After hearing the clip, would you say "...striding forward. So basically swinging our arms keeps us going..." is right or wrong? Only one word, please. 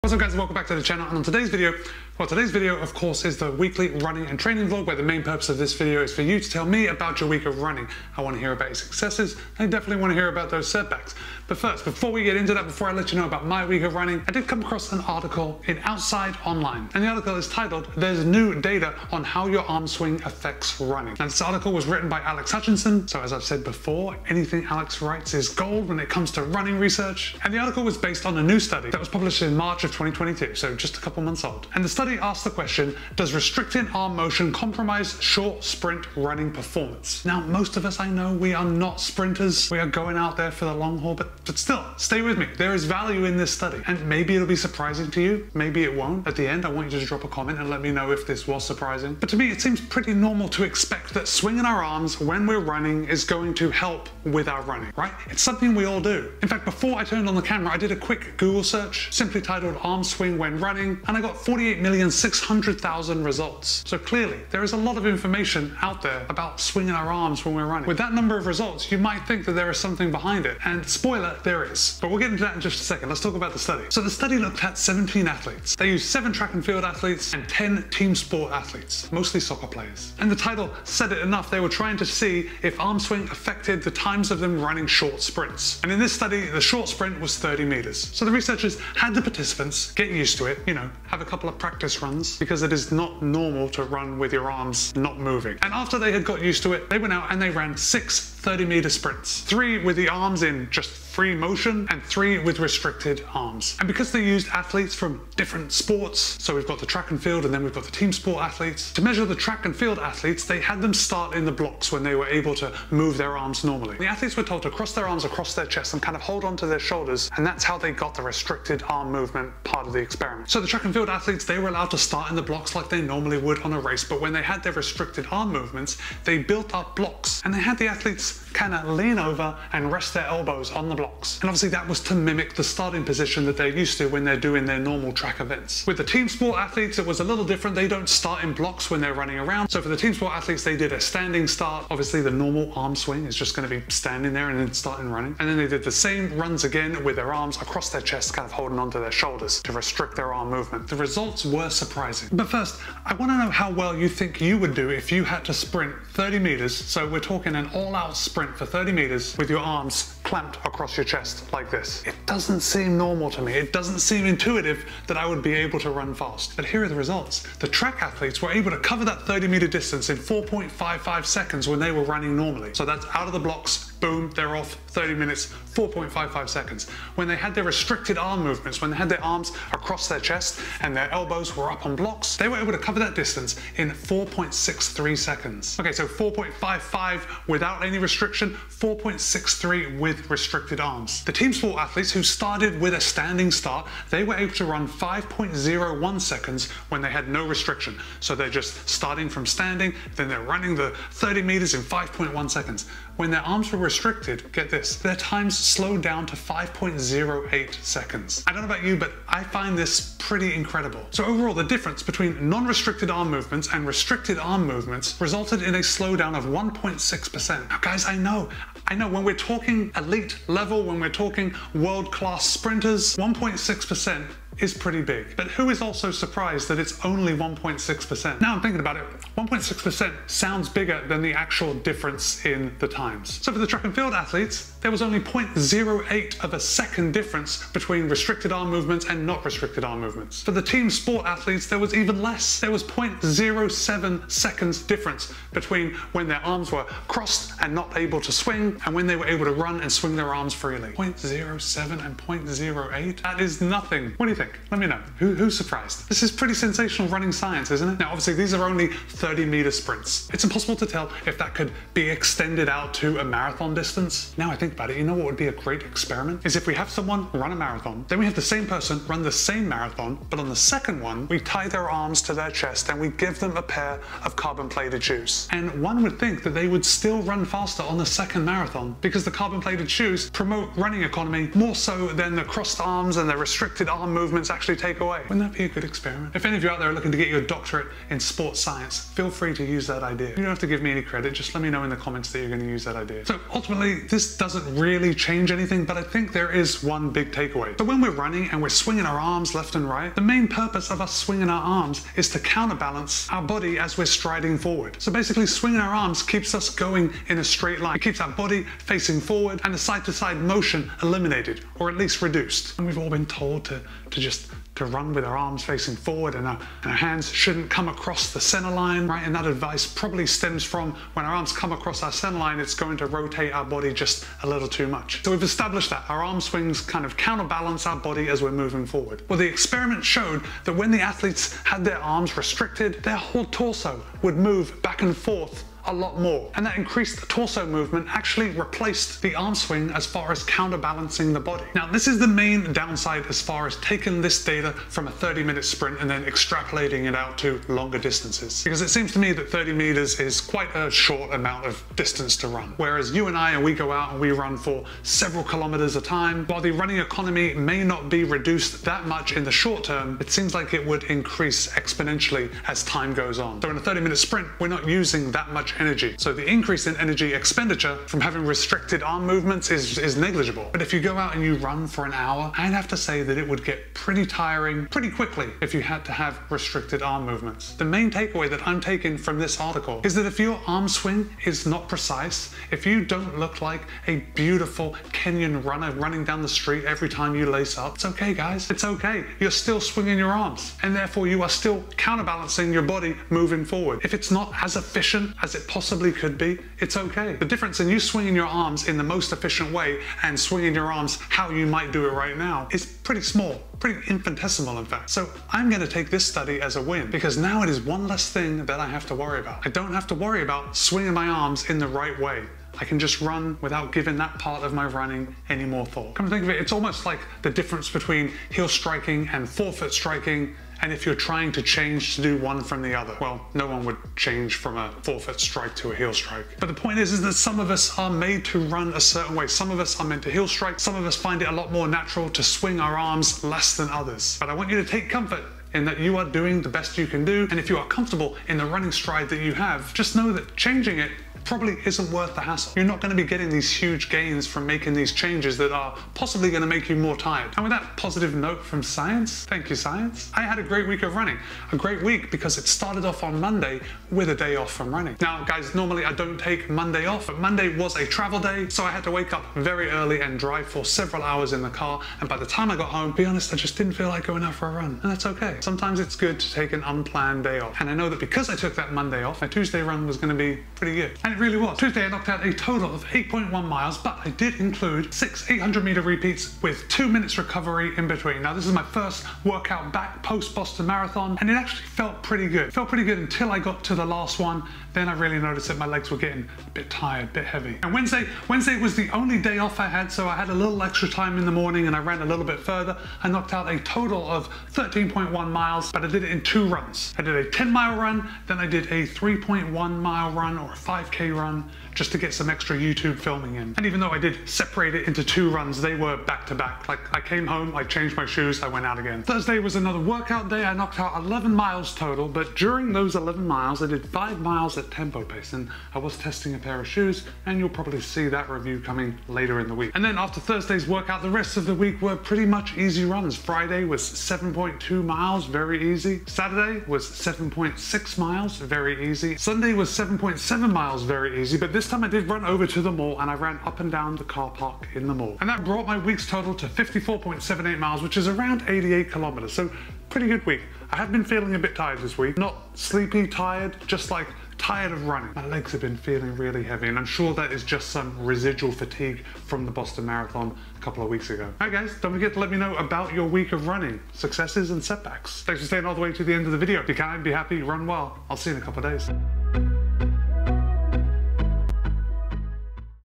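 right.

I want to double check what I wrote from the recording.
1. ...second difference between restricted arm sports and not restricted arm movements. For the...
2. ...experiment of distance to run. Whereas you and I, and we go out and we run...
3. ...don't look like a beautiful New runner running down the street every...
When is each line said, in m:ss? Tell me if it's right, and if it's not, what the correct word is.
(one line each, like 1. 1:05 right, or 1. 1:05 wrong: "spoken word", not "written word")
1. 3:56 wrong: "movements", not "sports"
2. 5:51 wrong: "amount", not "experiment"
3. 6:23 wrong: "Kenyan", not "New".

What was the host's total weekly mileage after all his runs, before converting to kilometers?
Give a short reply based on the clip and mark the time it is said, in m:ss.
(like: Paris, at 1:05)
54.78 miles, at 8:56.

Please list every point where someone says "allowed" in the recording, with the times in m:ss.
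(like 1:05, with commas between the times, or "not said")
2:01.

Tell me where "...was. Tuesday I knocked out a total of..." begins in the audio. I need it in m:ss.
7:51.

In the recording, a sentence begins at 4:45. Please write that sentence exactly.
Wouldn't that be a good experiment?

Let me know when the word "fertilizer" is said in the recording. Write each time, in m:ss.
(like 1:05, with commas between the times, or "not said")
not said.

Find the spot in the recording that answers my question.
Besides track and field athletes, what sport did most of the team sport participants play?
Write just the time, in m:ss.
1:19.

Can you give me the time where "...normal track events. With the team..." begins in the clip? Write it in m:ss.
2:14.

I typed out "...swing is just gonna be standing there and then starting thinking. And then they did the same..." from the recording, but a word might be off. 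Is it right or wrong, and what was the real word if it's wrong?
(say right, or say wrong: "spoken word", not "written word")
wrong: "running", not "thinking".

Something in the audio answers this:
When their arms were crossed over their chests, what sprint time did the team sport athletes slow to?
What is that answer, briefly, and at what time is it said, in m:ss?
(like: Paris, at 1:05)
5.08 seconds, at 3:26.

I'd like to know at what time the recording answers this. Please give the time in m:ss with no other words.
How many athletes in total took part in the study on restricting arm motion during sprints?
1:14.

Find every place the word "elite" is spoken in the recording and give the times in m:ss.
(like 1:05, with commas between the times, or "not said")
3:39.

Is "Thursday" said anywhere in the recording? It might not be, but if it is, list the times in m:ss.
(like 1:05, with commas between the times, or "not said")
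8:29, 8:40.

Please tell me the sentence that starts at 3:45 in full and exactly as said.
But who is also surprised that it's only 1.6%?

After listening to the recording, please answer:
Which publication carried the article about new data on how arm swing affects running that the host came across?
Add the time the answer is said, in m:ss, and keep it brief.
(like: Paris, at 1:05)
Outside Online, at 0:15.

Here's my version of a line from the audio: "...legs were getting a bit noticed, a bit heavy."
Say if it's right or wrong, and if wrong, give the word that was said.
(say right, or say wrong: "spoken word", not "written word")
wrong: "tired", not "noticed".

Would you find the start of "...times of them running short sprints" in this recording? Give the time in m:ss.
1:23.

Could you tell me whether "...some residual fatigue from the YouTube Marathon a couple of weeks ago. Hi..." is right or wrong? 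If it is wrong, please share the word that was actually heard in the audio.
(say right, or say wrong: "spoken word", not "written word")
wrong: "Boston", not "YouTube".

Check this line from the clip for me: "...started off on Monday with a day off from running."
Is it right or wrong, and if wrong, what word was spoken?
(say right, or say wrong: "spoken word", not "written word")
right.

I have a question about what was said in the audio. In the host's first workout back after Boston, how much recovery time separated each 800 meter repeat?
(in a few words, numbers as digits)
2 minutes.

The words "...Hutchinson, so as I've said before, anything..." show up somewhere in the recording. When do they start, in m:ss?
0:22.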